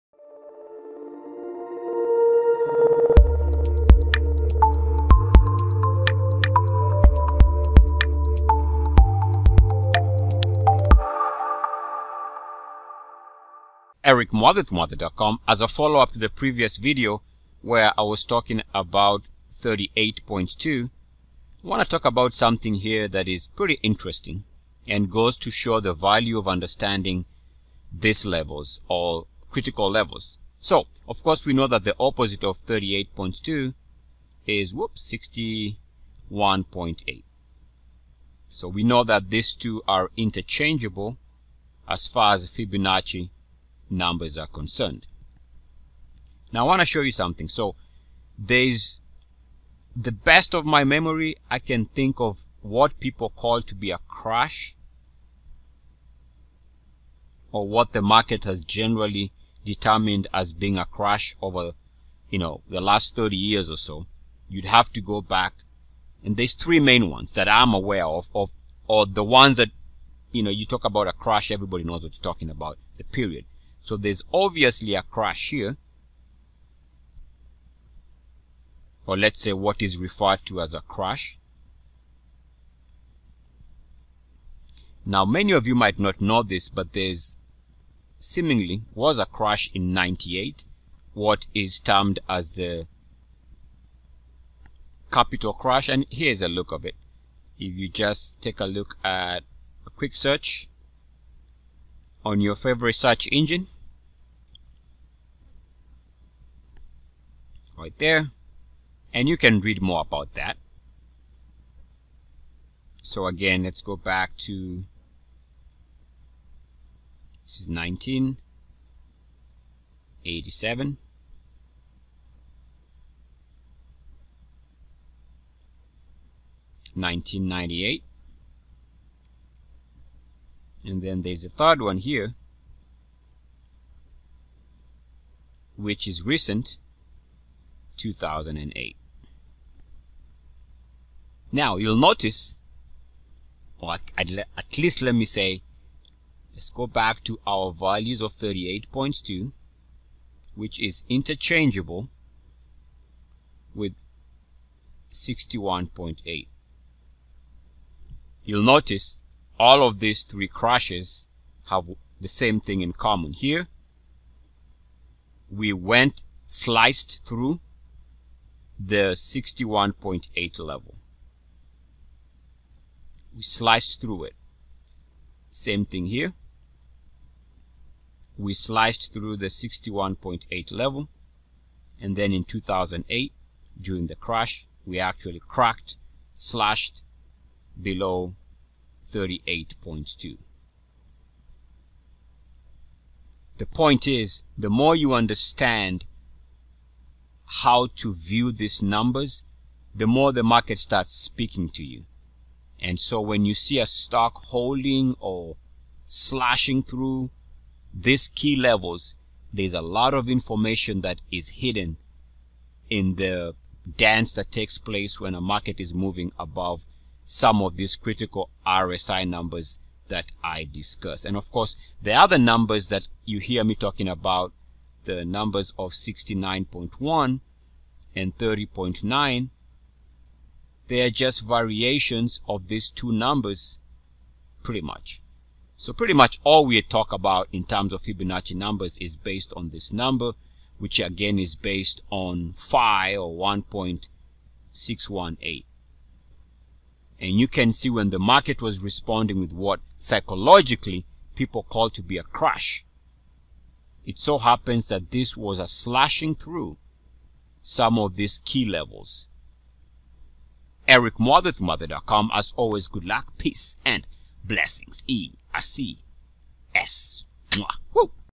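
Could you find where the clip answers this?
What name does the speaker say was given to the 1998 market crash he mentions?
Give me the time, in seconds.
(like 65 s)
92 s.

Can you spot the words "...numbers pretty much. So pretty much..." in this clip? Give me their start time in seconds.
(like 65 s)
233 s.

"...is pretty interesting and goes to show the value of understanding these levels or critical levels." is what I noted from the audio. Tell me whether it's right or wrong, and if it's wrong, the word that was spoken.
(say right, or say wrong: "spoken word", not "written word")
right.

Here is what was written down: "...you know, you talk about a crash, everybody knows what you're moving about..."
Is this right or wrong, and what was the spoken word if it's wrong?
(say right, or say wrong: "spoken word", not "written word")
wrong: "talking", not "moving".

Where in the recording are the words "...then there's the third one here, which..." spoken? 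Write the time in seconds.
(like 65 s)
131 s.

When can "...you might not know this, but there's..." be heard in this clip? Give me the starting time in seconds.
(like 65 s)
85 s.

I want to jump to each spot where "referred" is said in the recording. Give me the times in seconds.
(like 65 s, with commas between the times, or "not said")
79 s.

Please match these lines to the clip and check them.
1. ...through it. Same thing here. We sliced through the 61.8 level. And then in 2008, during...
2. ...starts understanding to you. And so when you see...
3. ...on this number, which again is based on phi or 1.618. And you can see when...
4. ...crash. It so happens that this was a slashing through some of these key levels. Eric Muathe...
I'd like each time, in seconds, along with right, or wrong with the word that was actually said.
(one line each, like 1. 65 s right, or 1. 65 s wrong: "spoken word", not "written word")
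1. 174 s right
2. 200 s wrong: "speaking", not "understanding"
3. 239 s right
4. 252 s right.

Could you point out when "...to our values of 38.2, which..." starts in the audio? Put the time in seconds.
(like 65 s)
147 s.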